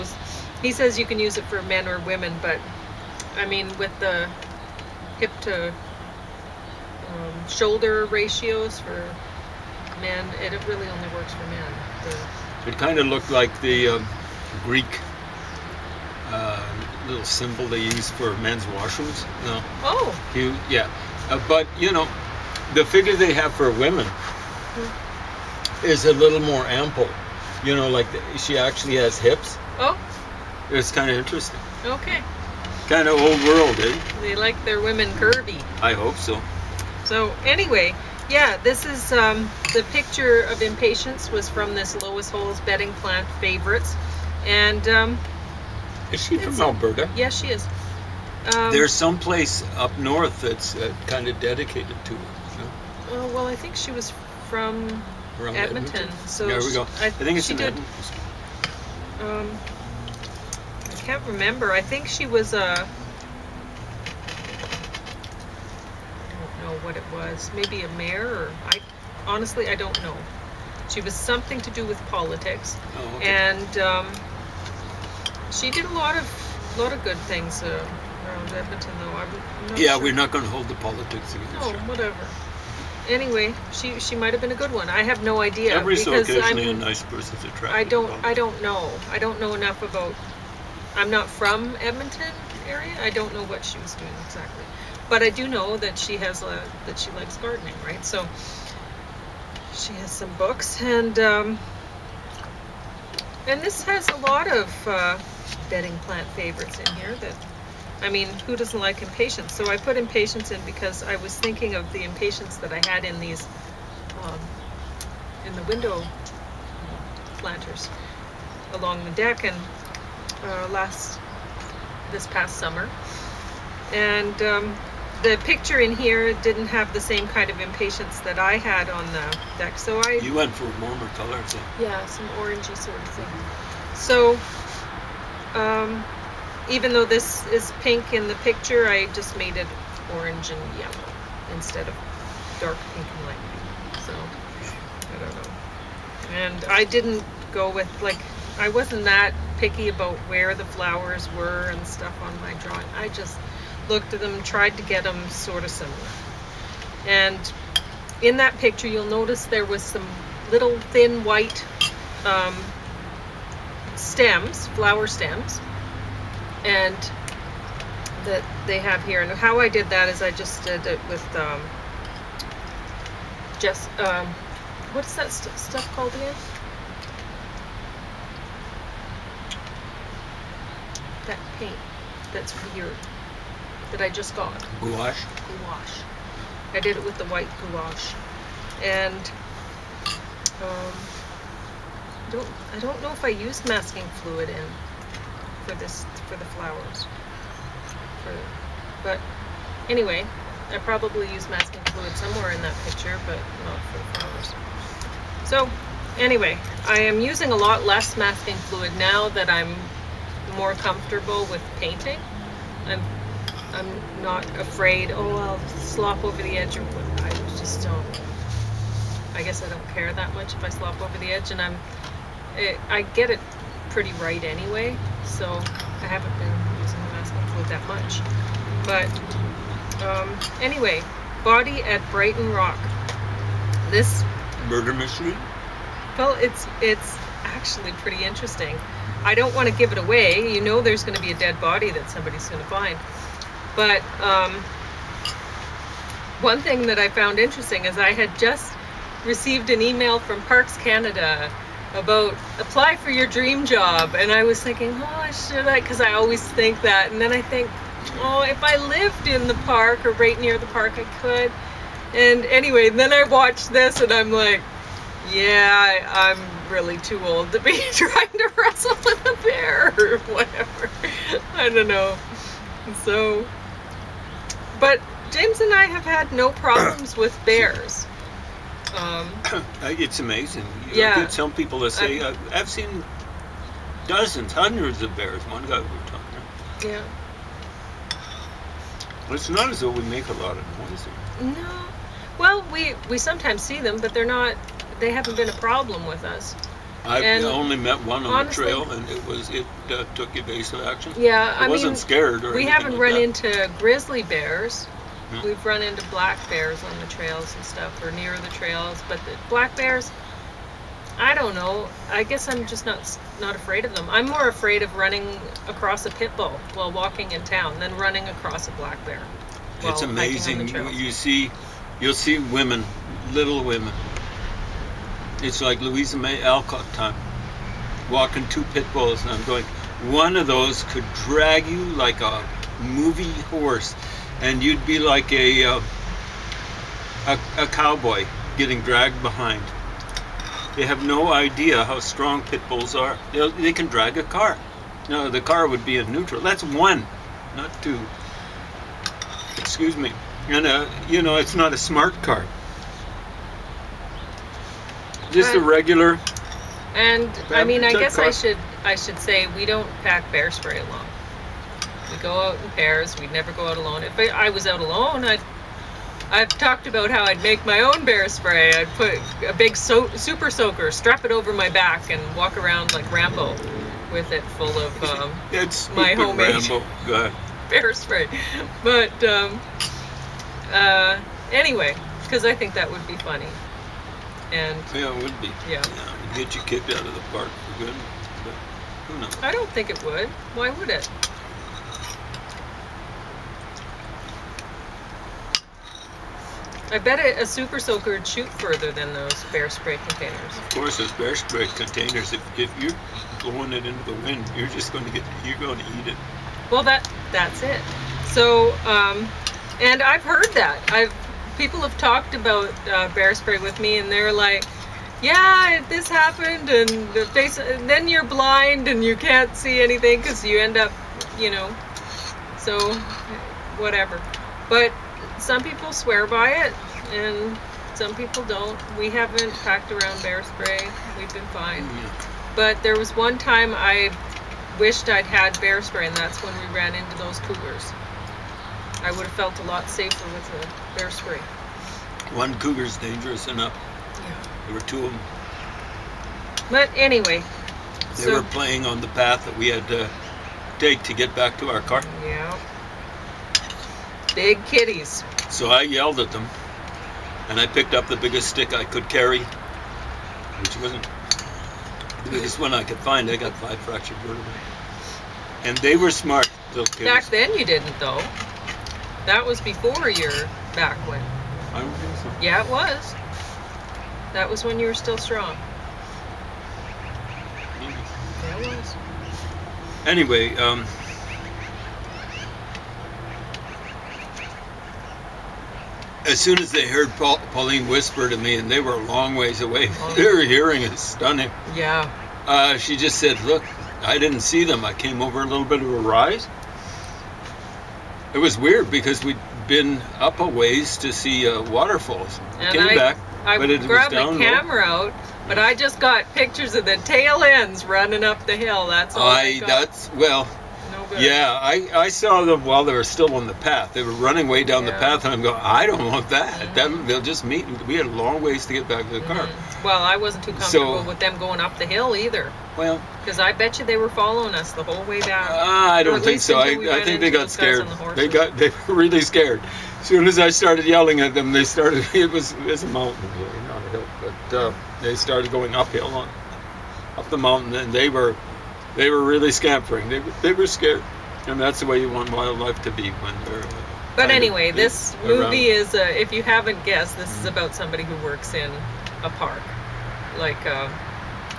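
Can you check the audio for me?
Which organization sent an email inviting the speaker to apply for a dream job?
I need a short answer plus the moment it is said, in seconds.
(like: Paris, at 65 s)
Parks Canada, at 250 s.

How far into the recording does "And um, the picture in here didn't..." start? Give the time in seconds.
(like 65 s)
123 s.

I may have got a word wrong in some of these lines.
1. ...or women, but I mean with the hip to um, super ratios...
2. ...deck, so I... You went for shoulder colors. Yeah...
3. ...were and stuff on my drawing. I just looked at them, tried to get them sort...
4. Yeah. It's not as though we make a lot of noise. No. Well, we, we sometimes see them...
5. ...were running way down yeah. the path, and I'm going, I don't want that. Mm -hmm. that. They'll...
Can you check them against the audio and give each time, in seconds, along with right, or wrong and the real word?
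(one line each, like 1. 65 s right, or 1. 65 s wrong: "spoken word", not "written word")
1. 1 s wrong: "shoulder", not "super"
2. 129 s wrong: "warmer", not "shoulder"
3. 151 s right
4. 286 s right
5. 514 s right.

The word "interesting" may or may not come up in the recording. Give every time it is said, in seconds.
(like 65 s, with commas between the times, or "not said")
31 s, 238 s, 247 s.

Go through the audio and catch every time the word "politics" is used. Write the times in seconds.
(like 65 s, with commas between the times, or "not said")
72 s, 80 s.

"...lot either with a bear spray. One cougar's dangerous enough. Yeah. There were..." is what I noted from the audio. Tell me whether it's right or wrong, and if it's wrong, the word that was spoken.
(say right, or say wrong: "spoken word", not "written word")
wrong: "safer", not "either".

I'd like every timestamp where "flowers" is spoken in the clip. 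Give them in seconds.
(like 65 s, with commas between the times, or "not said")
150 s, 164 s, 196 s, 204 s.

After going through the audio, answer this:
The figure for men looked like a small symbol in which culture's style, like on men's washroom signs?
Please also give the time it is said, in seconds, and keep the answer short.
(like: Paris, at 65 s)
Greek, at 14 s.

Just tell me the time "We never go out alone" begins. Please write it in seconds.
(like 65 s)
363 s.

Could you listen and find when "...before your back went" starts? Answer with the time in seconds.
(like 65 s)
469 s.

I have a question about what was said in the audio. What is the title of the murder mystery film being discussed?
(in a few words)
Body at Brighton Rock.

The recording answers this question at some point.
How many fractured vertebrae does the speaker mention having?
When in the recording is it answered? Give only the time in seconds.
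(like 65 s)
463 s.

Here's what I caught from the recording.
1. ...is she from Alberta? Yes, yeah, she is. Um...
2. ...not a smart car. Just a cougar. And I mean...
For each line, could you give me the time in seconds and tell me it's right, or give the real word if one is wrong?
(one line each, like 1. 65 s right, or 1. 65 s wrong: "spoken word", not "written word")
1. 46 s right
2. 351 s wrong: "regular", not "cougar".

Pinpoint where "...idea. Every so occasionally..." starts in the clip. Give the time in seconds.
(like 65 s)
85 s.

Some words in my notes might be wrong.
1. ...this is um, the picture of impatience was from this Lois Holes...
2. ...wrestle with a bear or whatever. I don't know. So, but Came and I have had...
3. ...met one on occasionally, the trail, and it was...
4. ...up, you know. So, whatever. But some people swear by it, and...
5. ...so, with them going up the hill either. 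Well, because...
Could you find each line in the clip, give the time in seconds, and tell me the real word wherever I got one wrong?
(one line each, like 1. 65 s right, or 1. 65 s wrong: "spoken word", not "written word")
1. 38 s right
2. 268 s wrong: "James", not "Came"
3. 297 s wrong: "honestly", not "occasionally"
4. 420 s right
5. 520 s right.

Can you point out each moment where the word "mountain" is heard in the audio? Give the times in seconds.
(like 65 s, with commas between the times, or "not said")
532 s, 537 s.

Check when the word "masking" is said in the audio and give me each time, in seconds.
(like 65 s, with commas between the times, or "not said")
193 s, 201 s, 208 s, 227 s.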